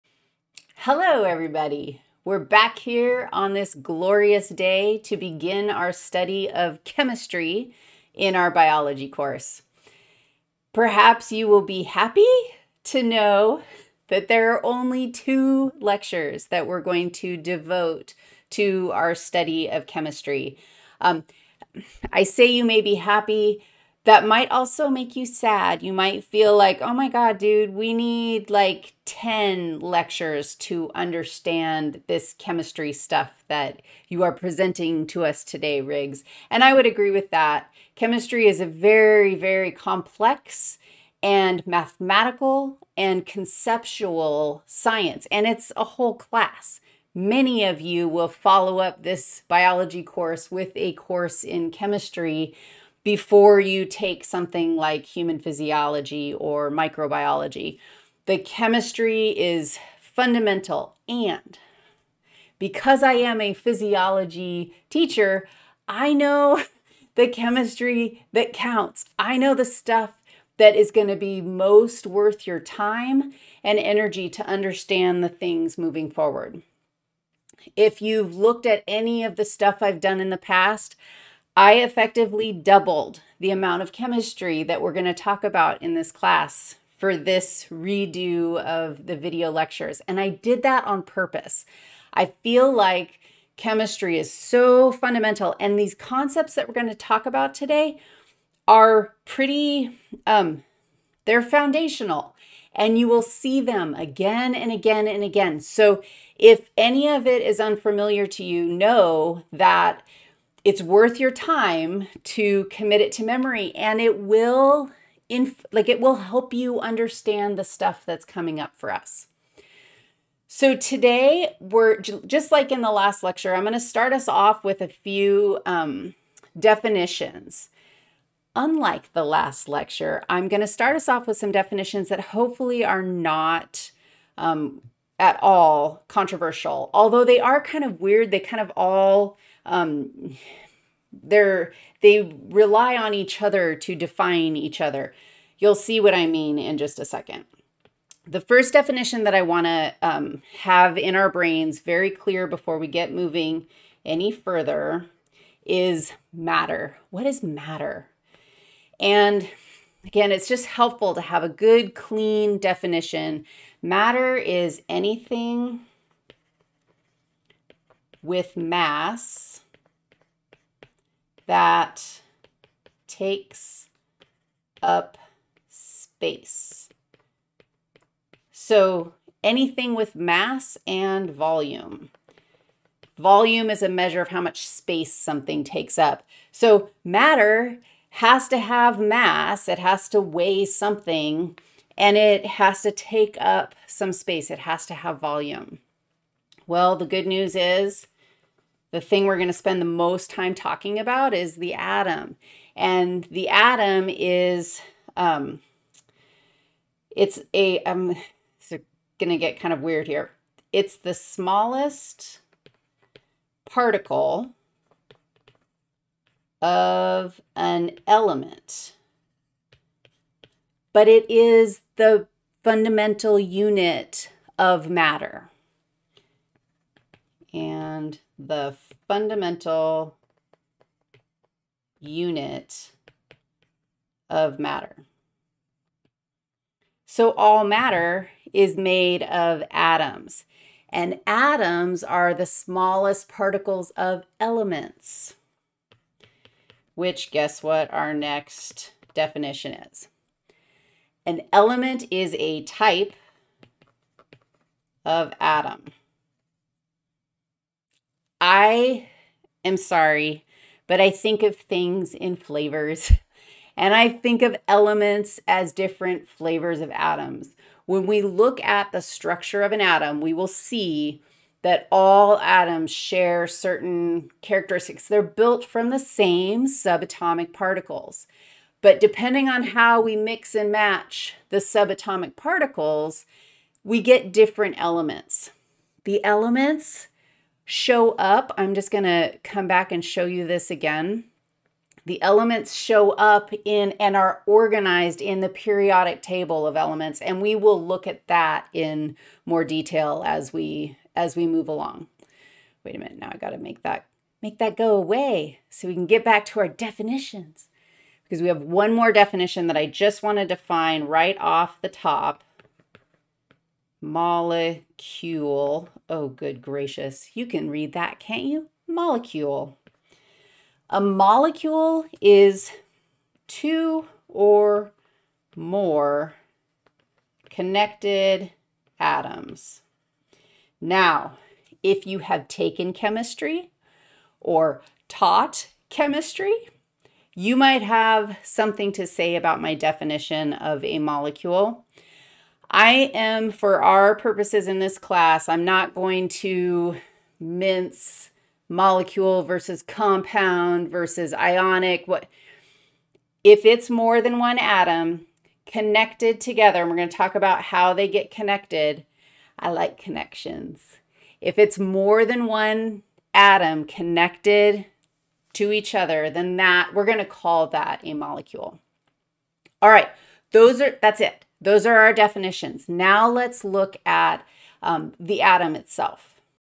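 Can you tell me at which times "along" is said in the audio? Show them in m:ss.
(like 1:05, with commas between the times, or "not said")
5:01.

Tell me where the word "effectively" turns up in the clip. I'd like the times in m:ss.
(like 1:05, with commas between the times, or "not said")
1:21.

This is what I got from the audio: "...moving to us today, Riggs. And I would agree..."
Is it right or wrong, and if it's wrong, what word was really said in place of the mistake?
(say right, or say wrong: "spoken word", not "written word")
wrong: "presenting", not "moving".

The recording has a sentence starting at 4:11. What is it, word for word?
An element is a type of atom.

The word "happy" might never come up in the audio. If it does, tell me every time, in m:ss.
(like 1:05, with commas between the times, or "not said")
0:11, 0:22.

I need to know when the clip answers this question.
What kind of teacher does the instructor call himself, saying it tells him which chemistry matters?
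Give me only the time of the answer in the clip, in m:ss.
1:03.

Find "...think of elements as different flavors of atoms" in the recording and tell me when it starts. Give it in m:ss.
4:24.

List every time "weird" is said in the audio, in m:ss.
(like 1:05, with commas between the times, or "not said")
2:18, 3:29.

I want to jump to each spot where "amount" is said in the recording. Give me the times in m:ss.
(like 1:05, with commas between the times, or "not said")
1:23.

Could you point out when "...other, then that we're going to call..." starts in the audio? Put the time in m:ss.
6:05.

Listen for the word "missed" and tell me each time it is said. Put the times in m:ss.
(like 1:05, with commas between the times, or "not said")
not said.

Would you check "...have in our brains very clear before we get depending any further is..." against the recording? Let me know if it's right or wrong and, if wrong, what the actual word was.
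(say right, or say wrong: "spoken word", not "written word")
wrong: "moving", not "depending".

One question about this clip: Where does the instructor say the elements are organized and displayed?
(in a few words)
Periodic table of elements.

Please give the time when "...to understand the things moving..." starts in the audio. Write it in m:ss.
1:14.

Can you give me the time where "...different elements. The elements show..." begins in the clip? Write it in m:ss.
4:44.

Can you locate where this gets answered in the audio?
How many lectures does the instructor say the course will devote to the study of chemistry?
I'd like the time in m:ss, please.
0:15.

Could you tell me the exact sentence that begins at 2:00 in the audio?
So today we're just like in the last lecture, I'm going to start us off with a few um, definitions.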